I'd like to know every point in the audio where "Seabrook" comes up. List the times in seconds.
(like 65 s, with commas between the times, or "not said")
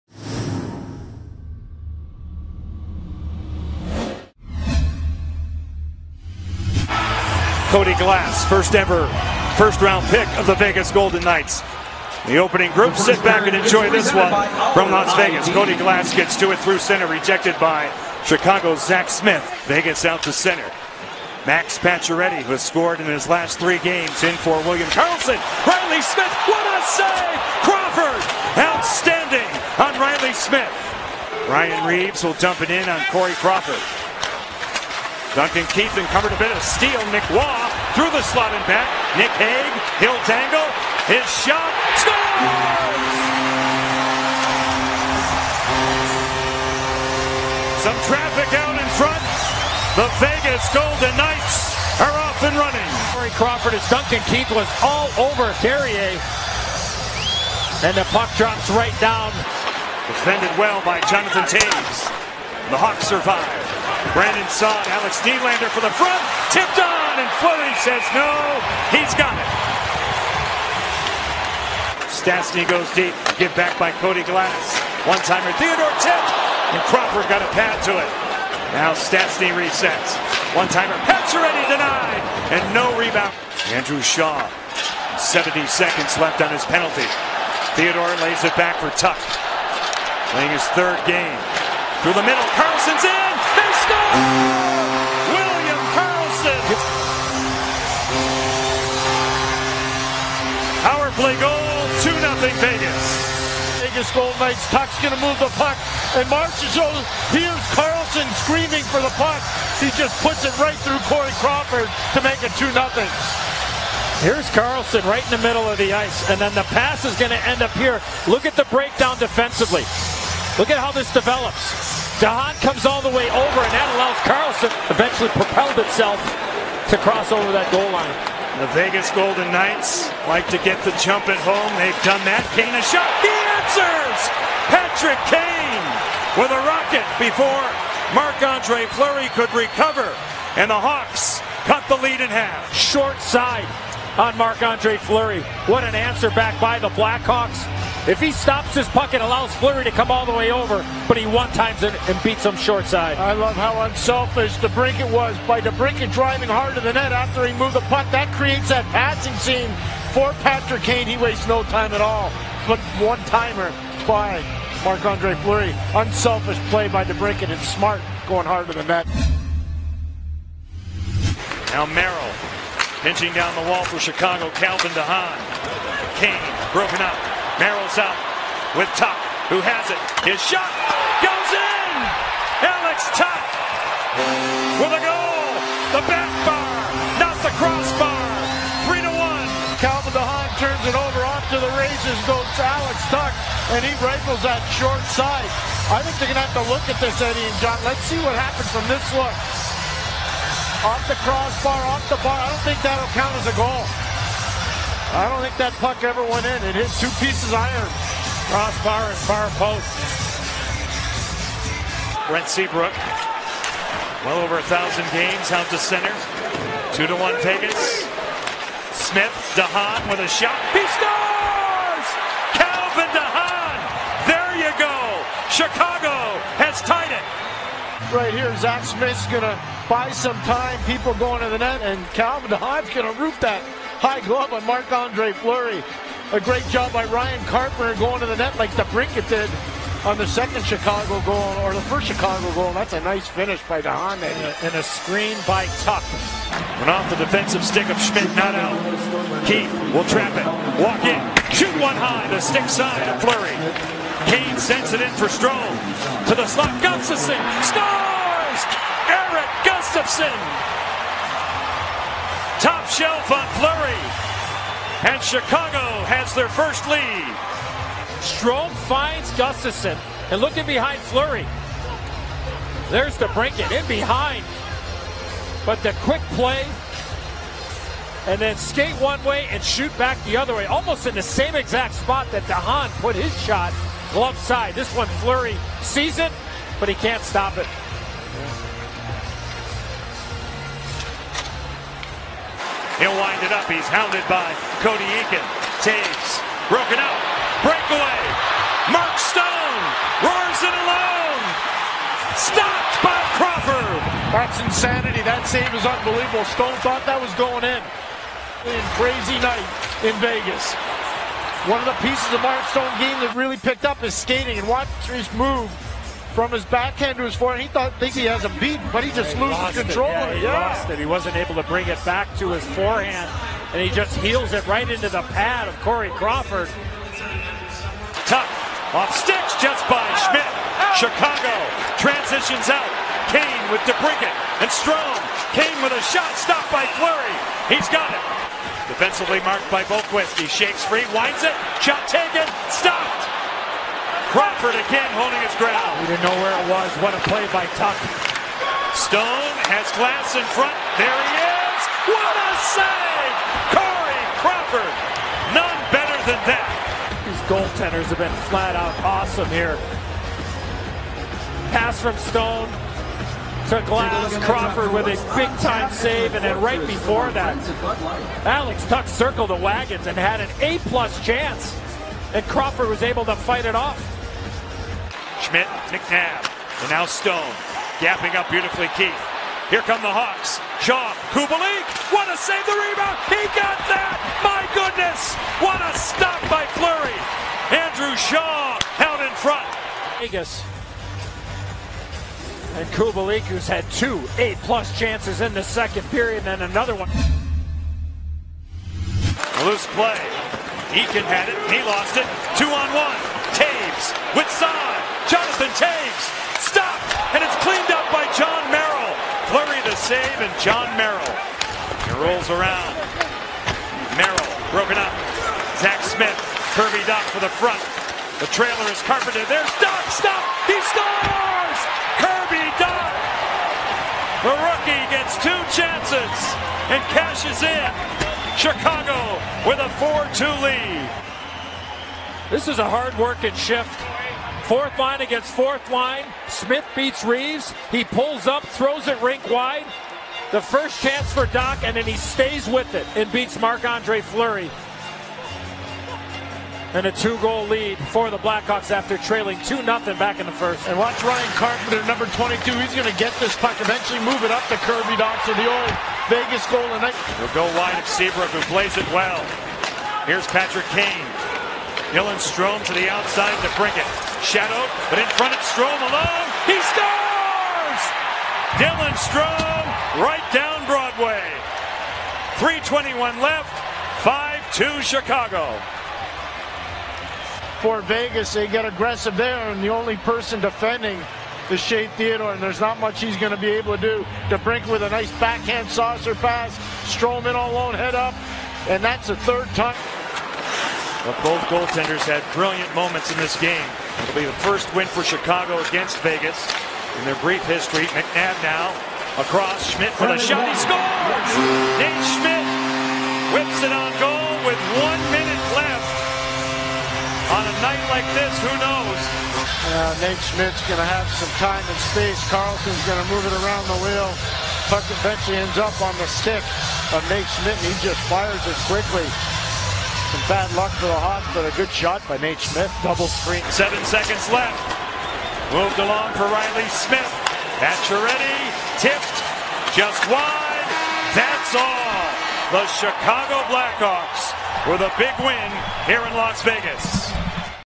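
212 s, 458 s.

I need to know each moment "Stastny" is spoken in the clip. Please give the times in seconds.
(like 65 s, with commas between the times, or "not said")
72 s, 78 s.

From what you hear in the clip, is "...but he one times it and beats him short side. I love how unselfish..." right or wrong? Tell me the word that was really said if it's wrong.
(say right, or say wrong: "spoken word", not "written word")
right.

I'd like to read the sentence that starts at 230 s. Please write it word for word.
People going to the net, and Calvin DeHaan's going to root that high glove on Marc Andre Fleury.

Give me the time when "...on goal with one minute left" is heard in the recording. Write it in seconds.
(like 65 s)
503 s.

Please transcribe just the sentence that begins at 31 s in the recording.
Ryan Reaves will dump it in on Corey Crawford.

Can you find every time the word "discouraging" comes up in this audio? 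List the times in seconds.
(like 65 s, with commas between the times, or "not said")
not said.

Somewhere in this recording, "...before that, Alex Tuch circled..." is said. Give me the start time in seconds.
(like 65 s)
366 s.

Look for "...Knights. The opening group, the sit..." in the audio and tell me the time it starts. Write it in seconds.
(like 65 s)
11 s.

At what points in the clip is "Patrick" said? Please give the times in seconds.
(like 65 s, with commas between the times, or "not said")
134 s, 160 s, 460 s.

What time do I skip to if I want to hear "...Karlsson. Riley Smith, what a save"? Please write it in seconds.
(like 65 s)
24 s.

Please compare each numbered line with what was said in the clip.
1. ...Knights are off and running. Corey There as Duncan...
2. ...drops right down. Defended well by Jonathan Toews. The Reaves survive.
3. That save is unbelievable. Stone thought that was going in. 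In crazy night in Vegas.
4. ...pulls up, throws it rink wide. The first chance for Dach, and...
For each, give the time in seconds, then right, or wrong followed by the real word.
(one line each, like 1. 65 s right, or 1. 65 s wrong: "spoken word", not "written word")
1. 51 s wrong: "Crawford", not "There"
2. 58 s wrong: "Hawks", not "Reaves"
3. 305 s right
4. 438 s right.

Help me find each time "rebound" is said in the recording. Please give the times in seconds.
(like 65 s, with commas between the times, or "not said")
82 s, 382 s.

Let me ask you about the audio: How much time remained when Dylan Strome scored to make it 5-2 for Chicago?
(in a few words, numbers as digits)
3:21.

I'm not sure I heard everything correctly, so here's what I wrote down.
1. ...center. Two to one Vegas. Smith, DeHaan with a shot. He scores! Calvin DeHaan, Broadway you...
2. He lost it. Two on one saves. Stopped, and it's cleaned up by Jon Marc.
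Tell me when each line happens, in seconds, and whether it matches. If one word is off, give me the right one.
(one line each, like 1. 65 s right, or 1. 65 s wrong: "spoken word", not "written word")
1. 215 s wrong: "There", not "Broadway"
2. 401 s wrong: "Merrill", not "Marc".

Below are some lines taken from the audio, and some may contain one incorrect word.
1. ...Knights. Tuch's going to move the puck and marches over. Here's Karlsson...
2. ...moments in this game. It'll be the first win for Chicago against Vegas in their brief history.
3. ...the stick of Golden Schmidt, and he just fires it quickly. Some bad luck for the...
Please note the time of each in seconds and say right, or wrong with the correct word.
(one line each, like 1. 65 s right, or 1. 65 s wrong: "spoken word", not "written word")
1. 104 s right
2. 492 s right
3. 516 s wrong: "Nate", not "Golden".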